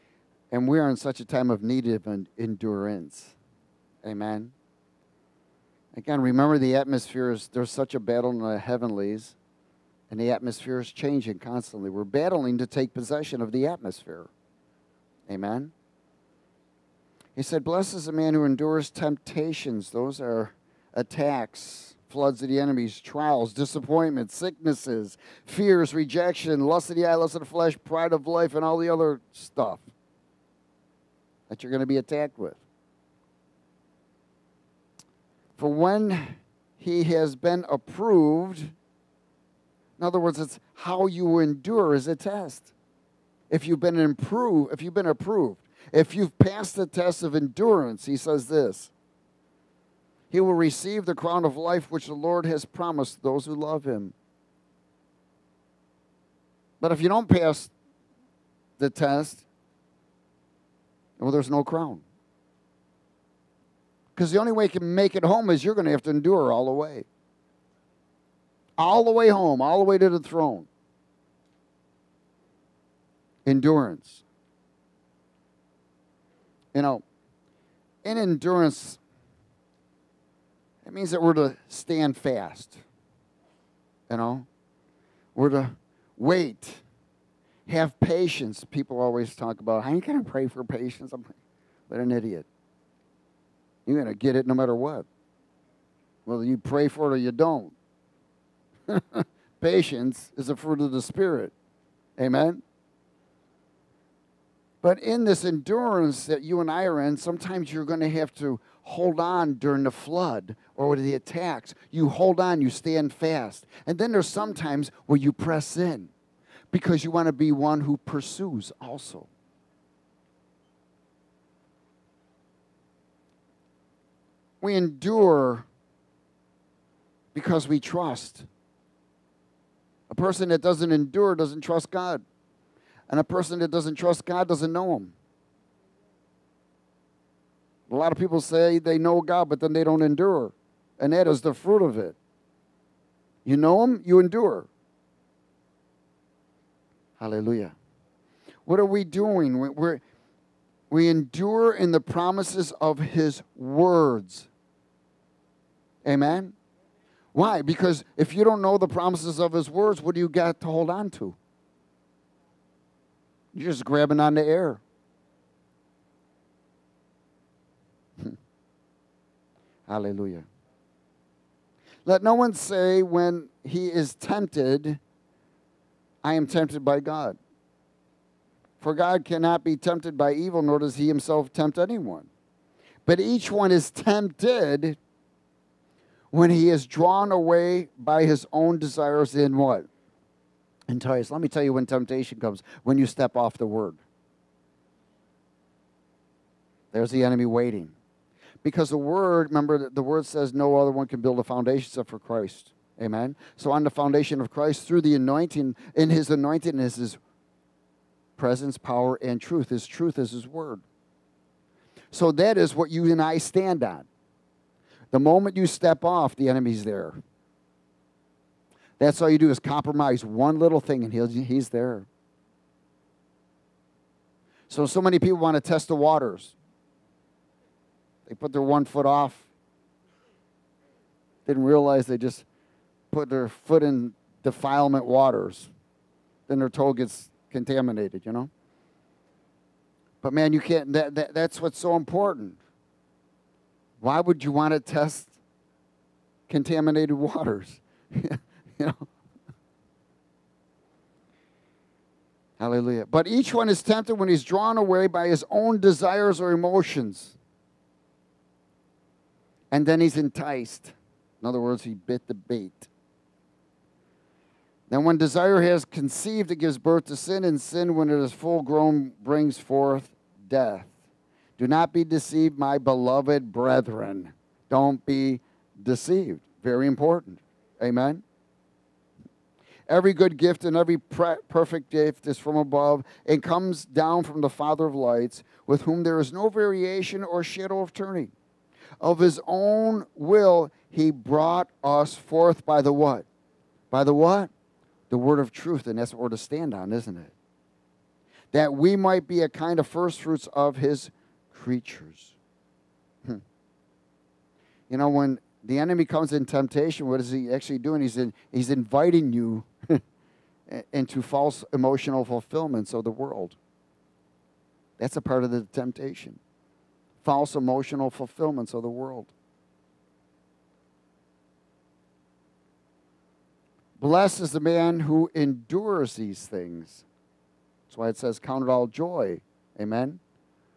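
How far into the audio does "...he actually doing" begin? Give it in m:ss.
5:07.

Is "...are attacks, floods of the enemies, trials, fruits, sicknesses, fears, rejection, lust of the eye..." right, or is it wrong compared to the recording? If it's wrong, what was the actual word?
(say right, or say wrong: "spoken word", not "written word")
wrong: "disappointments", not "fruits".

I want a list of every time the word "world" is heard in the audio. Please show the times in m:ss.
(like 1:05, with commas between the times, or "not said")
5:13, 5:18.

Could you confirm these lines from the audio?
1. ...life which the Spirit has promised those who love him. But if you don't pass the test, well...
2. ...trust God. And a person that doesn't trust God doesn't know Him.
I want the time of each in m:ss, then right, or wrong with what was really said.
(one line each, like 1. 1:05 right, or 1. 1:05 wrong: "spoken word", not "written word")
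1. 0:51 wrong: "Lord", not "Spirit"
2. 2:11 right.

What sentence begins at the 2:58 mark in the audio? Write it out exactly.
For God cannot be tempted by evil, nor does he himself tempt anyone.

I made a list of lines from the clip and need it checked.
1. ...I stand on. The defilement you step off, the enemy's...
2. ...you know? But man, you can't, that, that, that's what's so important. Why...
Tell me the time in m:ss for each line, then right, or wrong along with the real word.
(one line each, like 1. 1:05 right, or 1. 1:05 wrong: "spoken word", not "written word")
1. 3:33 wrong: "moment", not "defilement"
2. 3:58 right.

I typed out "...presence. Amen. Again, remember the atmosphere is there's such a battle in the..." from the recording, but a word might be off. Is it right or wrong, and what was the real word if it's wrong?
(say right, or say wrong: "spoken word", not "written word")
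wrong: "endurance", not "presence".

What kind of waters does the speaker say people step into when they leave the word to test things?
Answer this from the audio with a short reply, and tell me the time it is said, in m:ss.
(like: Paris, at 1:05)
Defilement waters, at 3:54.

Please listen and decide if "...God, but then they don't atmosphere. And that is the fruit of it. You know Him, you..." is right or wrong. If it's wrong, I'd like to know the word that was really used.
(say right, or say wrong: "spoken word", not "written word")
wrong: "endure", not "atmosphere".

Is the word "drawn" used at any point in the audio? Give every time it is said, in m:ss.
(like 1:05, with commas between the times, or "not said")
3:06, 4:14.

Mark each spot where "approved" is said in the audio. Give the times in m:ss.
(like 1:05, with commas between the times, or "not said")
0:37, 0:45.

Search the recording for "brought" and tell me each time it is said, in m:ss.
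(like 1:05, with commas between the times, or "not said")
4:51.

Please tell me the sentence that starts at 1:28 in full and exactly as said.
People always talk about, I ain't going to pray for patience.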